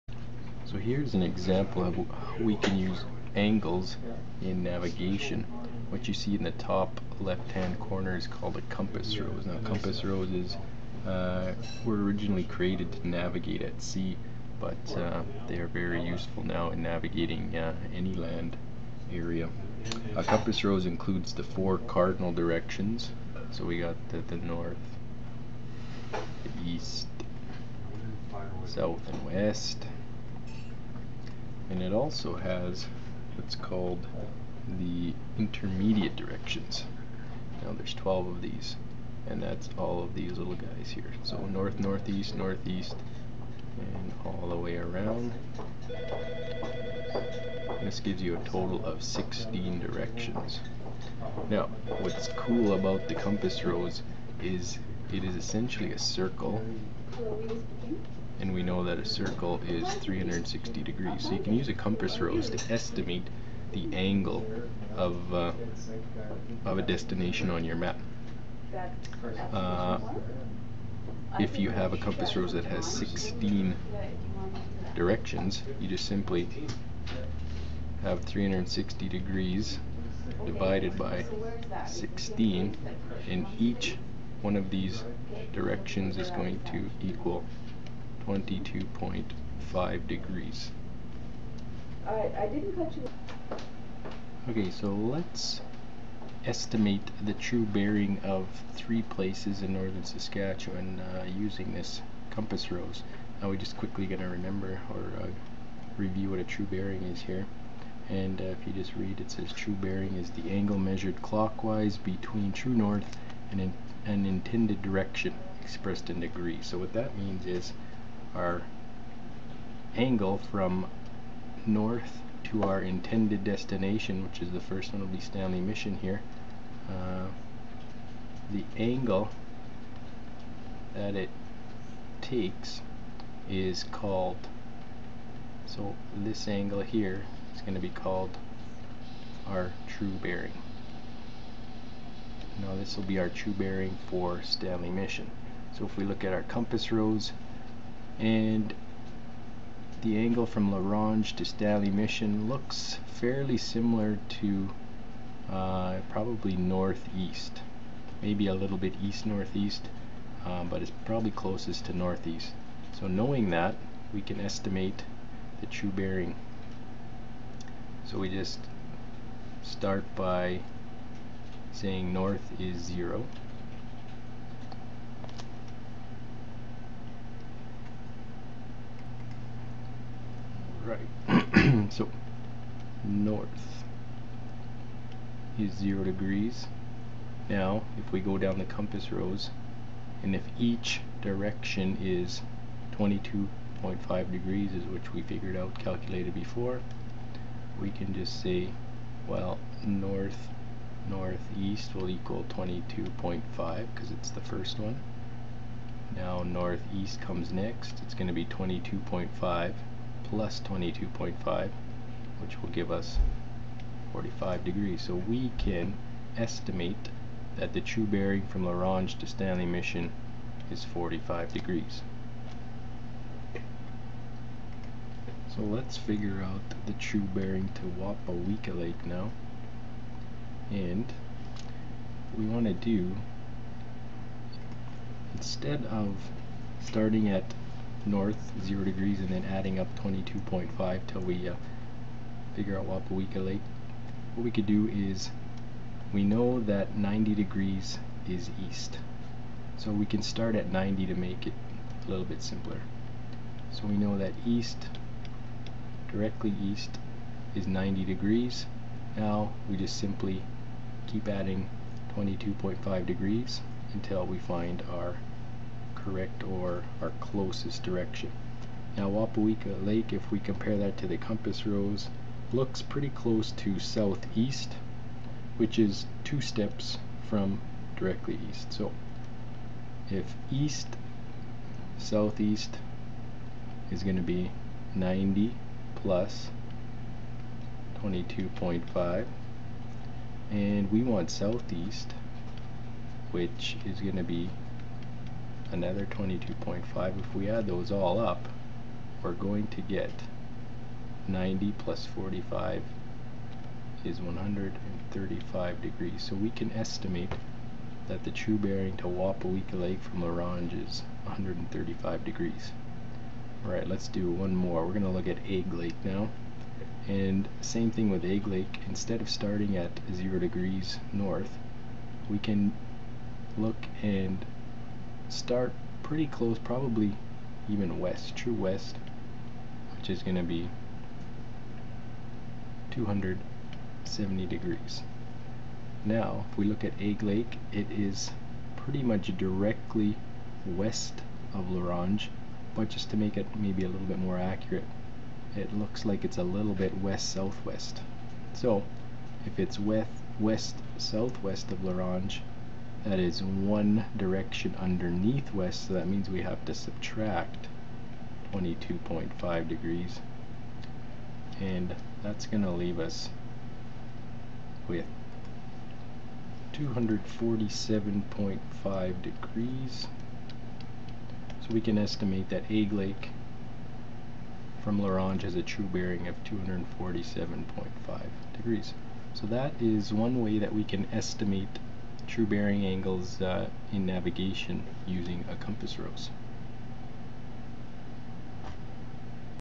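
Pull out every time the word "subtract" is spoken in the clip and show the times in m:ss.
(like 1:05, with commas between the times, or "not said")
5:56.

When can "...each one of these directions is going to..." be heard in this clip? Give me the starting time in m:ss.
1:23.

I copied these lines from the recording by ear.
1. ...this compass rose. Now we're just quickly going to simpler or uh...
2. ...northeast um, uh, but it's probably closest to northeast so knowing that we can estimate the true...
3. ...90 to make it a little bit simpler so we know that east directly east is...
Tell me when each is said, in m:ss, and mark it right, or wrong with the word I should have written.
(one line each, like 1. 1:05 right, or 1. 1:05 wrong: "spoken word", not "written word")
1. 1:41 wrong: "remember", not "simpler"
2. 2:39 right
3. 4:10 right.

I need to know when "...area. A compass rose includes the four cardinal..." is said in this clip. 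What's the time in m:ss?
0:19.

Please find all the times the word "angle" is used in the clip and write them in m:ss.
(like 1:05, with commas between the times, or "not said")
0:03, 1:03, 1:50, 1:59, 2:08, 2:16, 2:30, 6:22.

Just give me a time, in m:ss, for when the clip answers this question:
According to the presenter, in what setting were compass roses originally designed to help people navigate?
0:13.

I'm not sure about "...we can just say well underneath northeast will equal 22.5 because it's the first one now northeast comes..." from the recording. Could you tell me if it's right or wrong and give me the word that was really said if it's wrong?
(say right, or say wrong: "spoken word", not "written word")
wrong: "north", not "underneath".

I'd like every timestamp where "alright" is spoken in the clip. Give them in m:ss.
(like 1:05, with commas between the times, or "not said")
1:32, 5:13.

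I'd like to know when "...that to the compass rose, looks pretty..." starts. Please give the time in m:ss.
4:30.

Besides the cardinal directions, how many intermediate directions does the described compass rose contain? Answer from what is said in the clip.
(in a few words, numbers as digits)
12.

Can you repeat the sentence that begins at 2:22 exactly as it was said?
Now this will be our true bearing for Stanley Mission.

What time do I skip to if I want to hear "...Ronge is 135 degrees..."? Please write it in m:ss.
5:10.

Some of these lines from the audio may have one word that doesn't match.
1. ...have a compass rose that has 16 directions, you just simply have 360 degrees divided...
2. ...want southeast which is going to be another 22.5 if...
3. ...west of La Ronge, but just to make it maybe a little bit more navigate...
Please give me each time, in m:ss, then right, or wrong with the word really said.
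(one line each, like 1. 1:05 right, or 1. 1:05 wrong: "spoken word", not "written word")
1. 1:11 right
2. 4:51 right
3. 5:40 wrong: "accurate", not "navigate".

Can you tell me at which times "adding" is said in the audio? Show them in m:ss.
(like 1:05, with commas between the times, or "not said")
3:59, 4:21.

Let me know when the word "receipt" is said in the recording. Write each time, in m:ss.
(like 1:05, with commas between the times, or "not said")
not said.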